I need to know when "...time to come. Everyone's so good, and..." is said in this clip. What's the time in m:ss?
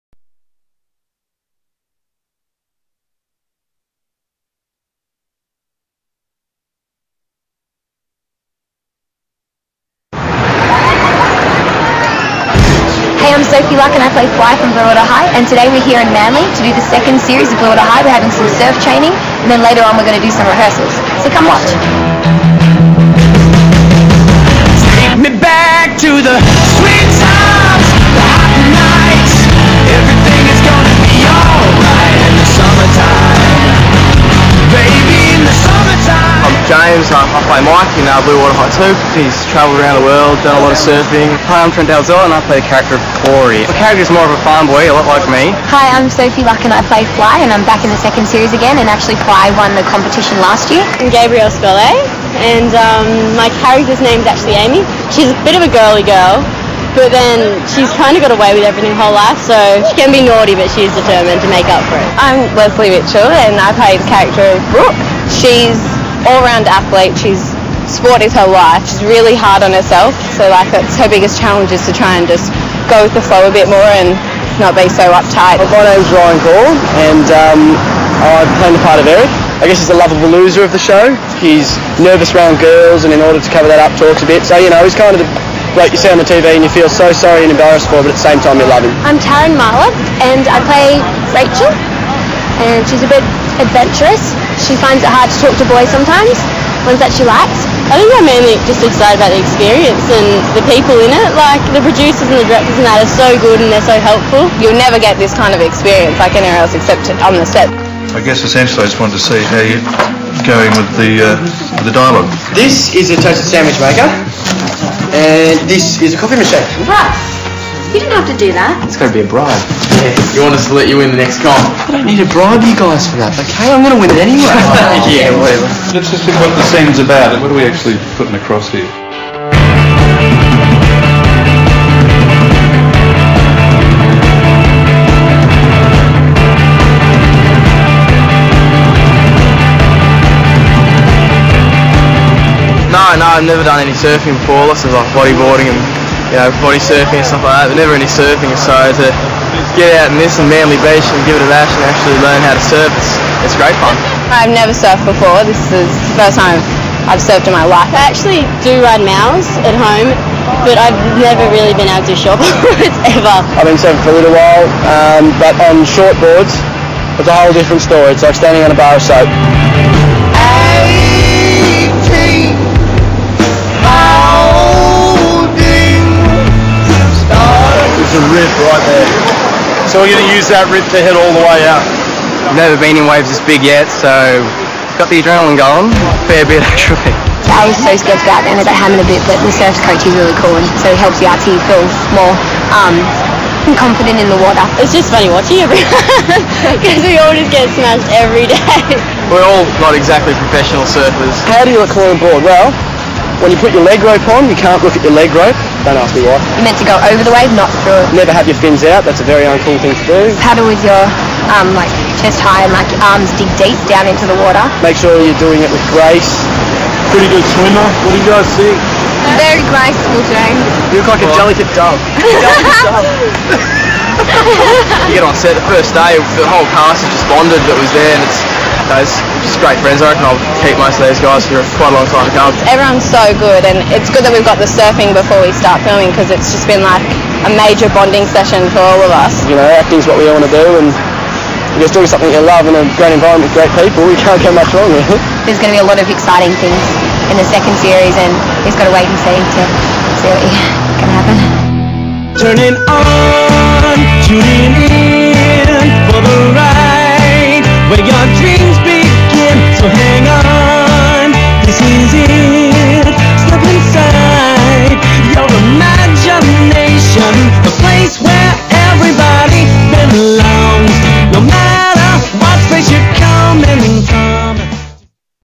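3:52.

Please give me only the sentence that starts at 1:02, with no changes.
I'm Lesley Mitchell, and I play the character of Brooke.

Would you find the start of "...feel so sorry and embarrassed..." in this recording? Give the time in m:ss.
1:26.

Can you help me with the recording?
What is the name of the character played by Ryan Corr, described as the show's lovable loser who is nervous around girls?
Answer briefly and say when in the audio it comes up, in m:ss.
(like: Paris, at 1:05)
Eric, at 1:19.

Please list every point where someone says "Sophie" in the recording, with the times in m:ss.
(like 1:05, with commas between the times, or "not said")
0:13, 0:46.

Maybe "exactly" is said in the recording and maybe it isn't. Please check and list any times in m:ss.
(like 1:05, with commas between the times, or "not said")
3:19.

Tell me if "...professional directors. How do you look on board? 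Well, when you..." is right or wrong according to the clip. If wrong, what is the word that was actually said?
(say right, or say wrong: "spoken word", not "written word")
wrong: "surfers", not "directors".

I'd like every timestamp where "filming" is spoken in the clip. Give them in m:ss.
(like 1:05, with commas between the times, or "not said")
3:55.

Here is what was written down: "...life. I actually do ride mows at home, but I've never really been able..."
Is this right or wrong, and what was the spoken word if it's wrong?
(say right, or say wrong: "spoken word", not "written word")
right.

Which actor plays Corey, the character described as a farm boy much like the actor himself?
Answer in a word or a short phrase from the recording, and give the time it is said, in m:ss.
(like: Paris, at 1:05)
Trent Dalzell, at 0:41.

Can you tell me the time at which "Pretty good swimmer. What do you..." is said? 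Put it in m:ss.
3:37.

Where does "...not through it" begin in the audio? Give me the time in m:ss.
3:27.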